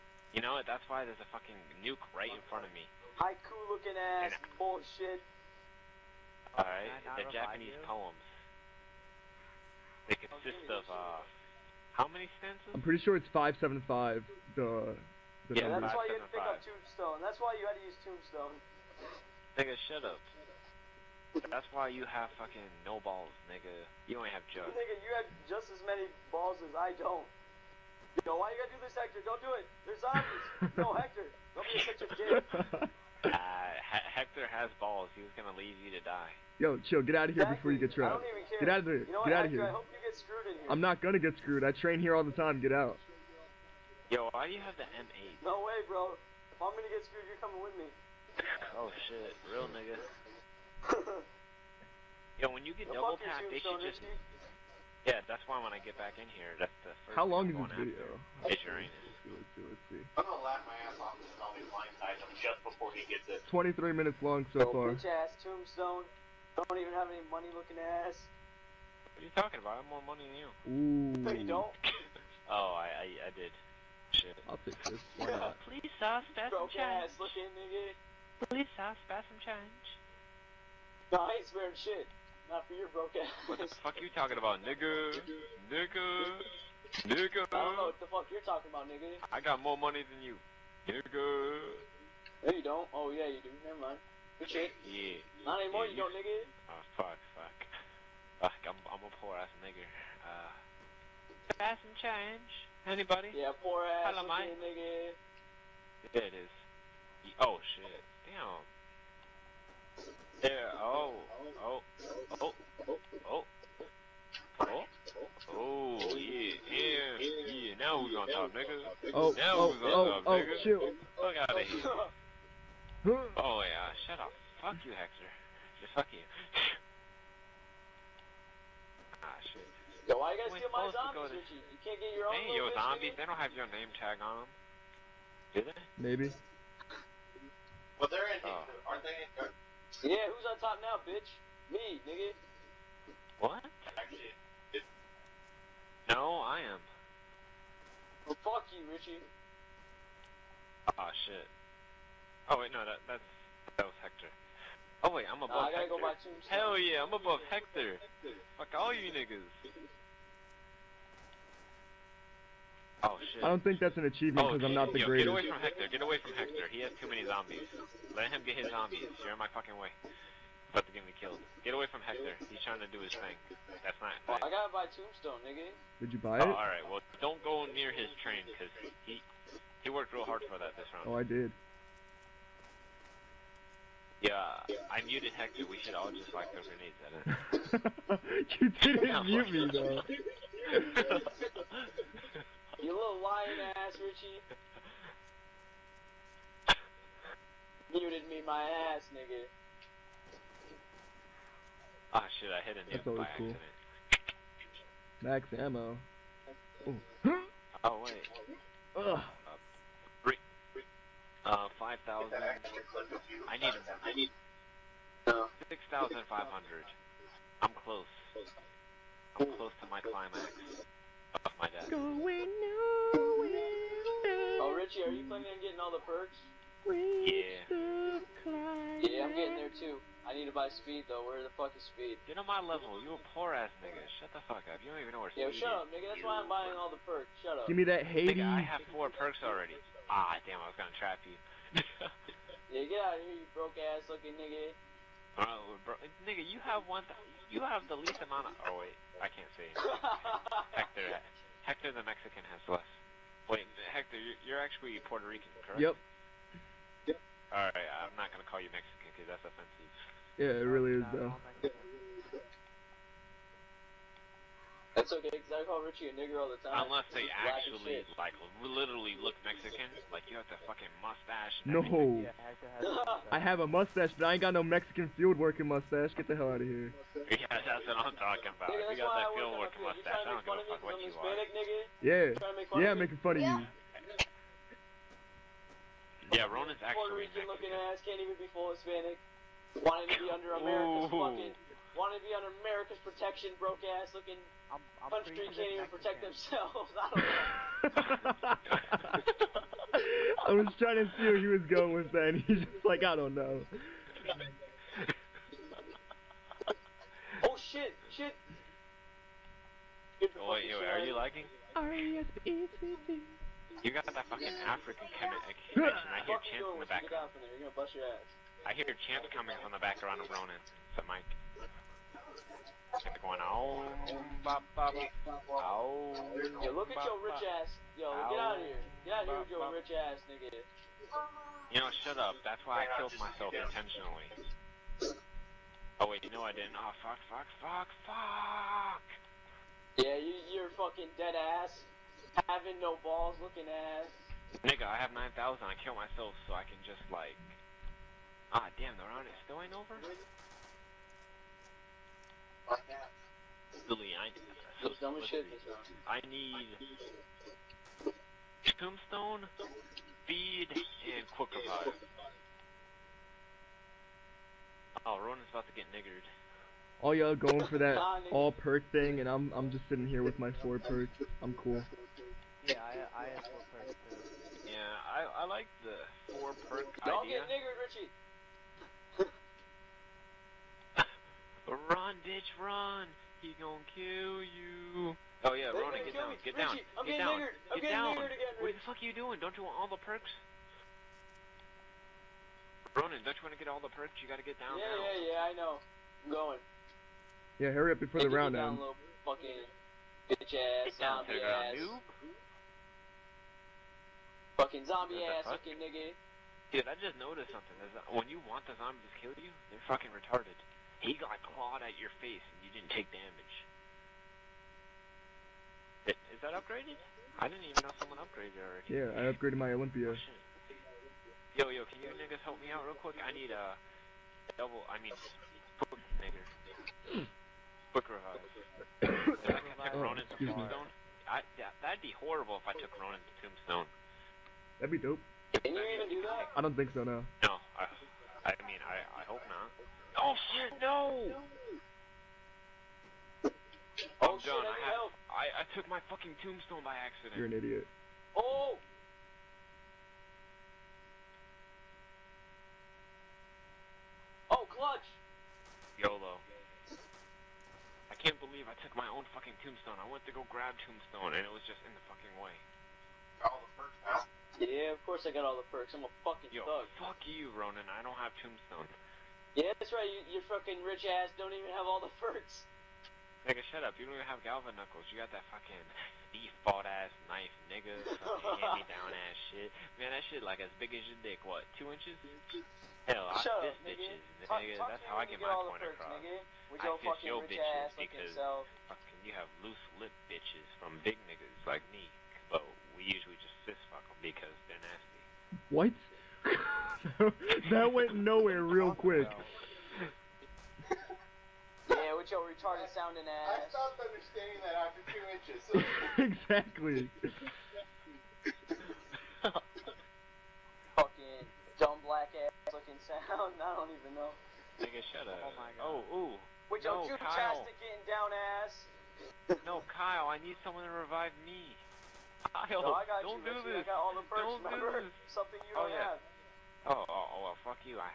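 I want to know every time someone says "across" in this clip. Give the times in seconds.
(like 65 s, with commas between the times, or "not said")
485 s.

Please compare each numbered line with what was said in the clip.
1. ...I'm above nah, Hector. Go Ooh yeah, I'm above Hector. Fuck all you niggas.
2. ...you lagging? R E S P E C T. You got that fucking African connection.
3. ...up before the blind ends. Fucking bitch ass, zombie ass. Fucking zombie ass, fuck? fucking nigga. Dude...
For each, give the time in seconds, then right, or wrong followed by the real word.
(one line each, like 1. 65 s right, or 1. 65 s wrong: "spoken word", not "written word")
1. 155 s wrong: "Hell", not "Ooh"
2. 311 s right
3. 397 s wrong: "round", not "blind".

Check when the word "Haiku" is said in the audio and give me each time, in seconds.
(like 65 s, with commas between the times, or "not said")
3 s.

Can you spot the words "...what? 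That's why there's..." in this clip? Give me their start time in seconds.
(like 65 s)
0 s.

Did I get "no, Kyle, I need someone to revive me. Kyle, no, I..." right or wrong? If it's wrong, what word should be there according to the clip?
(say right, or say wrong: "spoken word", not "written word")
right.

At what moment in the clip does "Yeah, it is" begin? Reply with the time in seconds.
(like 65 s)
106 s.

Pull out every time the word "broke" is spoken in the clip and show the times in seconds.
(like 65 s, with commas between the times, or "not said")
82 s, 243 s, 293 s.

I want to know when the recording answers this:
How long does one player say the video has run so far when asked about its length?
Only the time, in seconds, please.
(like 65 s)
63 s.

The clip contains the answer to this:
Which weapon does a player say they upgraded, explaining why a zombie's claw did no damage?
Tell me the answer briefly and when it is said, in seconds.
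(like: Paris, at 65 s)
Olympia, at 419 s.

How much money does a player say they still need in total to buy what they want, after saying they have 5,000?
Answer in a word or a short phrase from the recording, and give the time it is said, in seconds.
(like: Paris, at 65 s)
6,500, at 215 s.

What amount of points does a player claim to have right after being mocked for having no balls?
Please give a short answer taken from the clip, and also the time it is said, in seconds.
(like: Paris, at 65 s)
9,000, at 345 s.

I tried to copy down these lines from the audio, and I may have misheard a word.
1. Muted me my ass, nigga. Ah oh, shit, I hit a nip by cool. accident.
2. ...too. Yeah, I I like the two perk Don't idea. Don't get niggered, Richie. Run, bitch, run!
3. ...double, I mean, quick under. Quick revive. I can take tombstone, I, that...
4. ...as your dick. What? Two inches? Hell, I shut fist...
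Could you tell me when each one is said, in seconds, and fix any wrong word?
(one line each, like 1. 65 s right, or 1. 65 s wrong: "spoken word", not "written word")
1. 197 s right
2. 374 s wrong: "four", not "two"
3. 424 s wrong: "nigger", not "under"
4. 480 s right.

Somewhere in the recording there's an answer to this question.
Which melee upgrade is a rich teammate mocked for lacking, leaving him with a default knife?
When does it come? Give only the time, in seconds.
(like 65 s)
474 s.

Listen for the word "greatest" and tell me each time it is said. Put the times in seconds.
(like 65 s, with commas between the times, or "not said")
165 s.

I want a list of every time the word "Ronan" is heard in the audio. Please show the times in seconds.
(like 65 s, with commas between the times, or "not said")
286 s, 320 s, 365 s, 385 s, 392 s, 432 s, 467 s.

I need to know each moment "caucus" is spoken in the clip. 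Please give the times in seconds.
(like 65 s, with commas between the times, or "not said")
not said.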